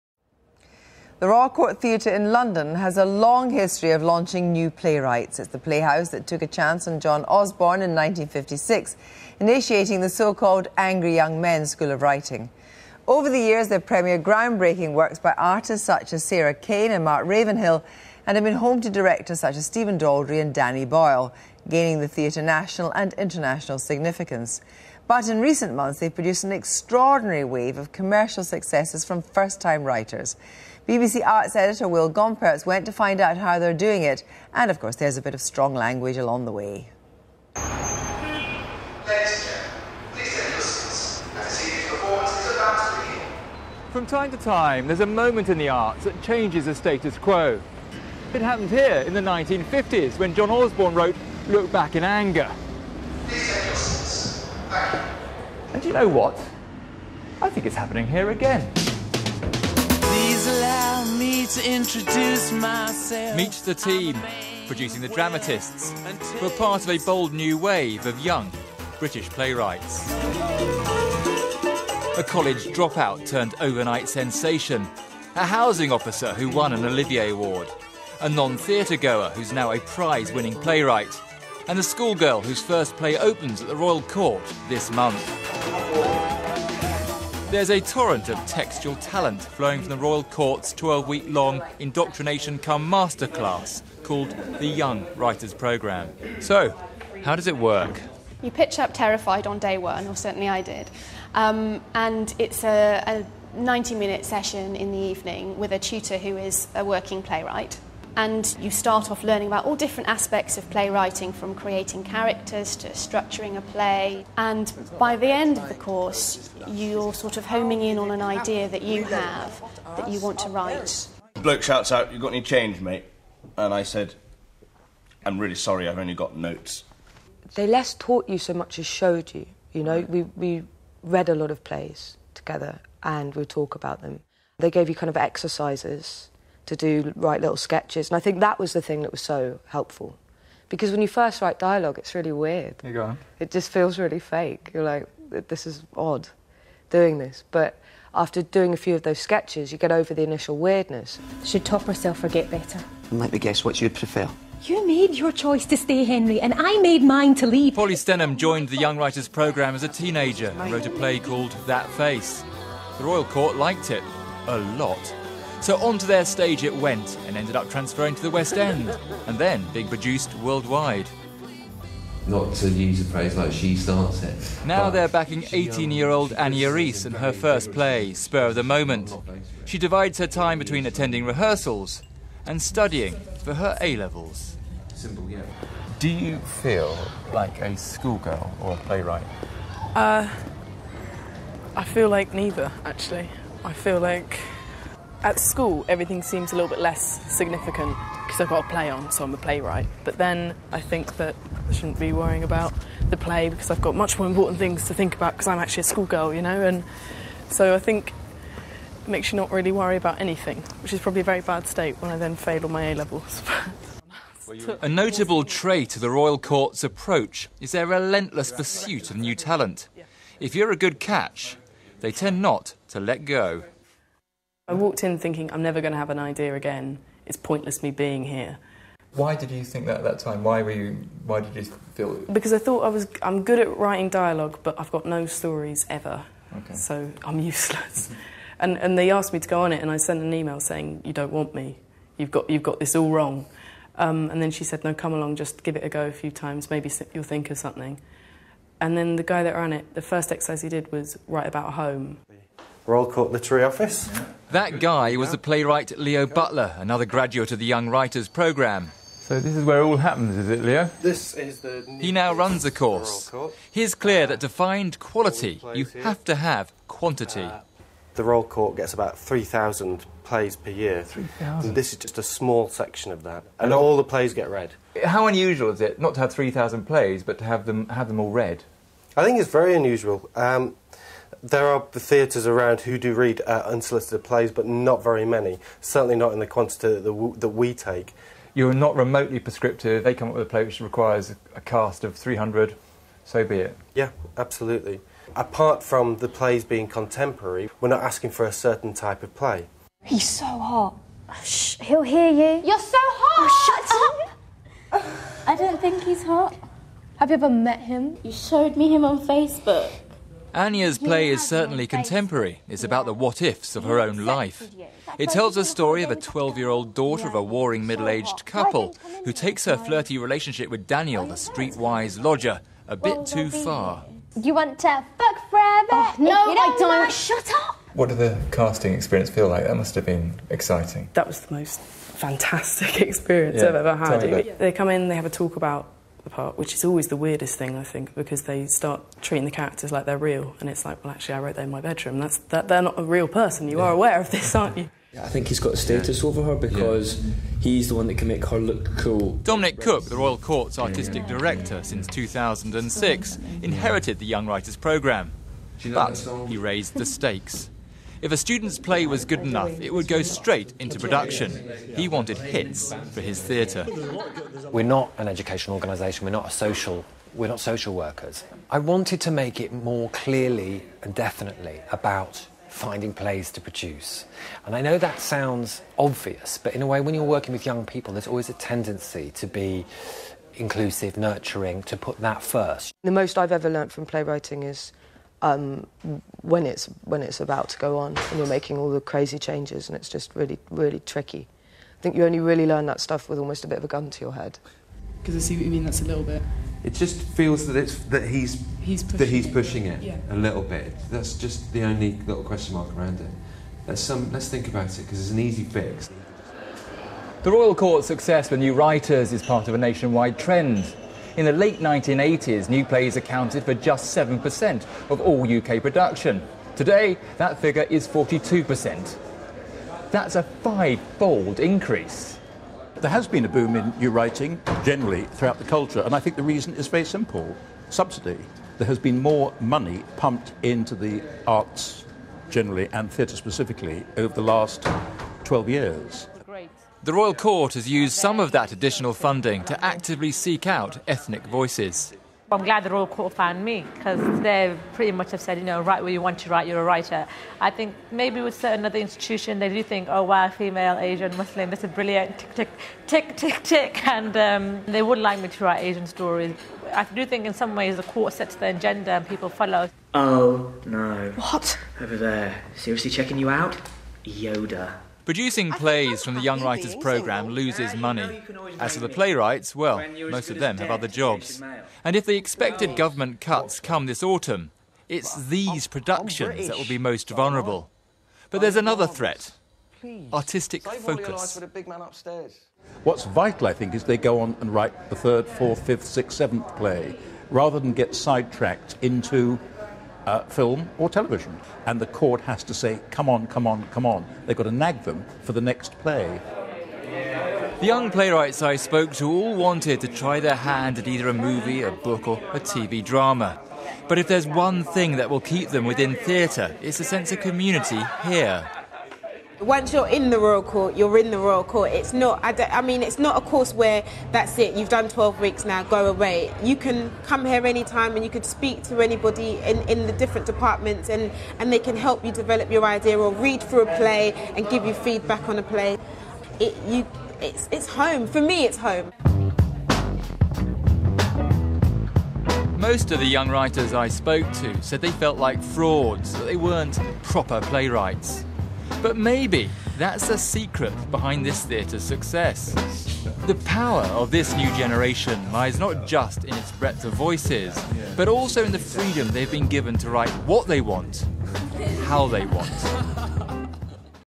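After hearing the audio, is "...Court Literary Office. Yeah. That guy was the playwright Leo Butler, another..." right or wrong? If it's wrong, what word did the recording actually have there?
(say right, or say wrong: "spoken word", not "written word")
right.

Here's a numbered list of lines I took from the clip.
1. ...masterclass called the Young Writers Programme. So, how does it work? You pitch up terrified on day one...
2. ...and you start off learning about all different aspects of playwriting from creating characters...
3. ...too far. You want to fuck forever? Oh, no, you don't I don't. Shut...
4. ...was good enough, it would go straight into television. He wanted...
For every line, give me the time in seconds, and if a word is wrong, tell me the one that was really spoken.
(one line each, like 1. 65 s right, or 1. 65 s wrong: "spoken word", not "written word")
1. 92 s right
2. 108 s right
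3. 323 s right
4. 359 s wrong: "production", not "television".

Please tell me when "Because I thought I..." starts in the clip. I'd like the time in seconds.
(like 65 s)
232 s.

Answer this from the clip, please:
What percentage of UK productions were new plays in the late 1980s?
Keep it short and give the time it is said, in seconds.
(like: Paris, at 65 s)
7%, at 414 s.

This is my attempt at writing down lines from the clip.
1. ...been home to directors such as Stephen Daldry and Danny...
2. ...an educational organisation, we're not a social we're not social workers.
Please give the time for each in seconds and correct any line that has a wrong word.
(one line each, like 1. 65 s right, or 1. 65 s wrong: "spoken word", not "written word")
1. 18 s right
2. 365 s right.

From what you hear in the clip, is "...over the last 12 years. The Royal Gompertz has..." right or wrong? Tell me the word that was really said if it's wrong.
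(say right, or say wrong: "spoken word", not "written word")
wrong: "Court", not "Gompertz".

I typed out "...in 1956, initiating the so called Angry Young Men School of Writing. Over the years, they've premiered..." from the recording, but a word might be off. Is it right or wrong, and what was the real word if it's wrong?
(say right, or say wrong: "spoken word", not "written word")
right.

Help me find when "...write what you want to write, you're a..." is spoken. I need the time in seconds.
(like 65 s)
445 s.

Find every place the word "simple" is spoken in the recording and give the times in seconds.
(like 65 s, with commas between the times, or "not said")
184 s, 427 s.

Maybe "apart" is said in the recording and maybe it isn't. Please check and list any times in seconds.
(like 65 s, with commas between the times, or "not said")
295 s, 336 s.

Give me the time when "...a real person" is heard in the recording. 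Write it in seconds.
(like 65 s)
342 s.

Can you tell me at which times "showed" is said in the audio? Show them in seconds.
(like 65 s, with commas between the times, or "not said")
128 s, 308 s.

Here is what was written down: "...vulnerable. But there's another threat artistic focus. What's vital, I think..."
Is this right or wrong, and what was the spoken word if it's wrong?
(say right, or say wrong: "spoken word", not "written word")
right.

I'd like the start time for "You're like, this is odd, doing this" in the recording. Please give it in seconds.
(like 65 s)
144 s.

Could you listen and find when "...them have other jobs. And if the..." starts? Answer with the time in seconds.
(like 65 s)
470 s.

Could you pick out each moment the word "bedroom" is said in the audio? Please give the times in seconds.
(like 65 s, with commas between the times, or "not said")
341 s.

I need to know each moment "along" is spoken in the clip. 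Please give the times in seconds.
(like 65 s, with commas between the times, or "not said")
36 s, 245 s.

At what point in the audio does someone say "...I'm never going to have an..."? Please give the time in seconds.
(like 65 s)
225 s.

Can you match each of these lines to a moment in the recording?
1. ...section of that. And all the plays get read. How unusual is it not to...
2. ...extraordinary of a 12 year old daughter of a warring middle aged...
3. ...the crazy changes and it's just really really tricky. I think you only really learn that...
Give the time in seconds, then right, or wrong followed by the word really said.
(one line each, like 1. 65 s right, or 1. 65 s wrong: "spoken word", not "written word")
1. 272 s right
2. 315 s wrong: "story", not "extraordinary"
3. 388 s right.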